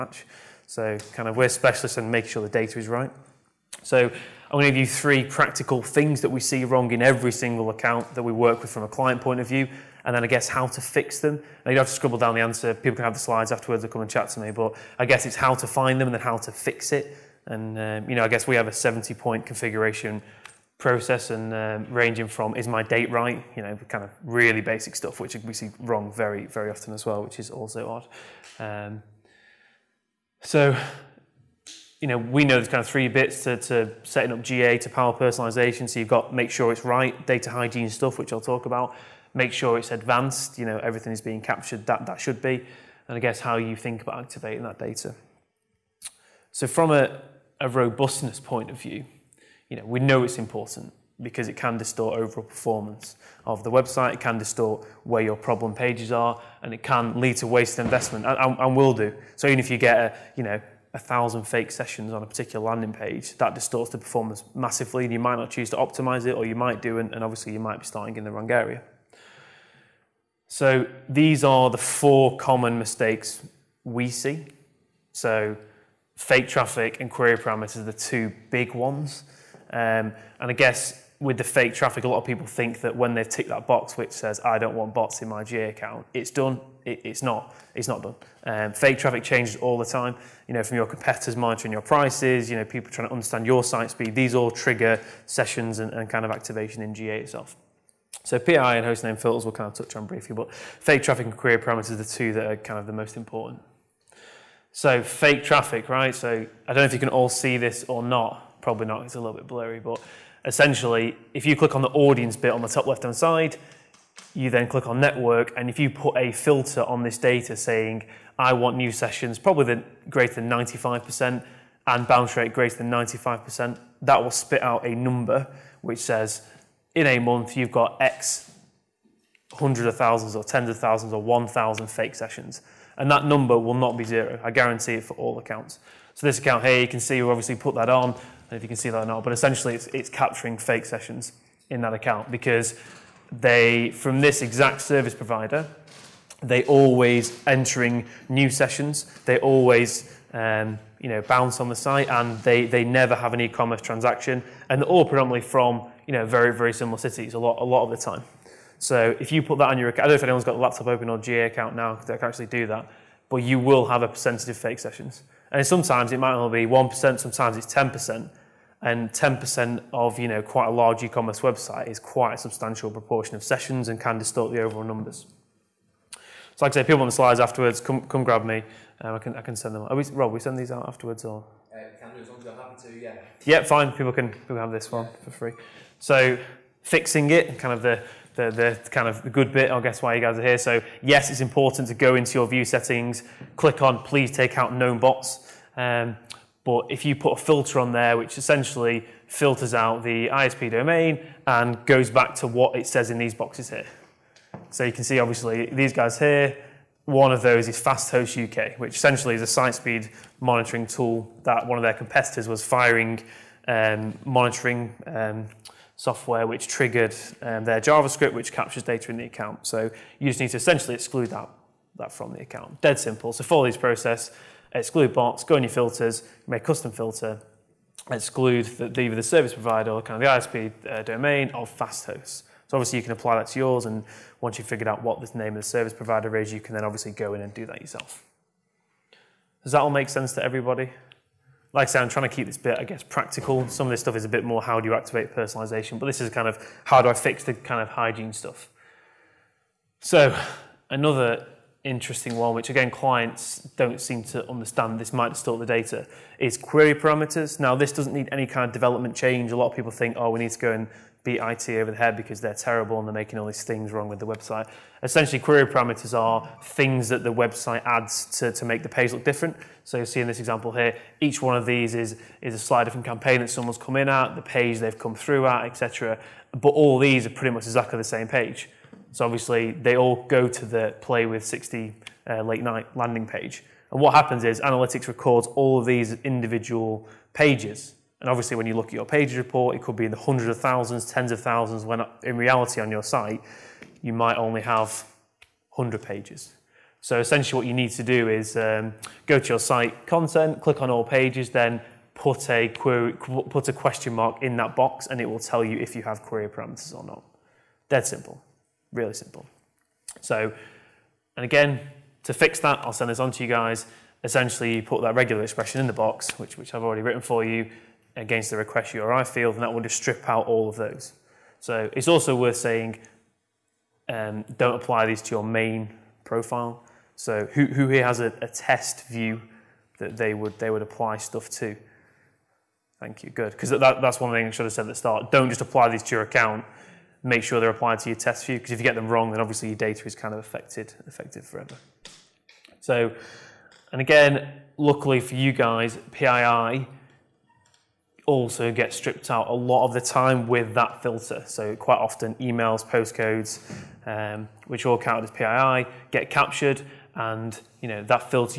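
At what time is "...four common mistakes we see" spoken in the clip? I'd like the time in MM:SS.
01:11.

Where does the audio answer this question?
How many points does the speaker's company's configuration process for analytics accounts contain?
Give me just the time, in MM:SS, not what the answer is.
00:18.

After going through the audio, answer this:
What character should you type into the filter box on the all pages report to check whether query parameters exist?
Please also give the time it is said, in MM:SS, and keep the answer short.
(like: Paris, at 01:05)
Question mark, at 05:03.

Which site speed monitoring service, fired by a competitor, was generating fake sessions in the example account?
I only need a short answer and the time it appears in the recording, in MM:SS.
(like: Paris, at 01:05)
Fasthost UK, at 03:27.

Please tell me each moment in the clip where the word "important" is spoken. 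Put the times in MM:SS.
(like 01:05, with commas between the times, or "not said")
00:50, 01:43, 03:11.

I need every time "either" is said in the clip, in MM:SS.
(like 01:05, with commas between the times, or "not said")
03:49.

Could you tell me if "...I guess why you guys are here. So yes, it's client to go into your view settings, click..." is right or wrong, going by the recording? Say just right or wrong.
wrong.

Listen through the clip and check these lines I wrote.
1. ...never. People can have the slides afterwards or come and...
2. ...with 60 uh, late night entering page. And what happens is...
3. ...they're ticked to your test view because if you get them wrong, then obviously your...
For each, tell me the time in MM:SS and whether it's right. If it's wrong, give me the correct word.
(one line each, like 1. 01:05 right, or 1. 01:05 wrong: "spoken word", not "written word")
1. 00:12 wrong: "answer", not "never"
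2. 04:41 wrong: "landing", not "entering"
3. 05:37 wrong: "applied", not "ticked".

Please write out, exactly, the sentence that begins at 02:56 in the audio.
So like I say, people on the slides afterwards, come, come grab me.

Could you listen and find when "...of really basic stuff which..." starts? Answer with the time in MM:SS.
00:24.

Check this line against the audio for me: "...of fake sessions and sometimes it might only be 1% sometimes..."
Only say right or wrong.
right.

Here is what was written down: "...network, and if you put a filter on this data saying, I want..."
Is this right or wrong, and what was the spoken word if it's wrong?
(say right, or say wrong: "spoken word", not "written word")
right.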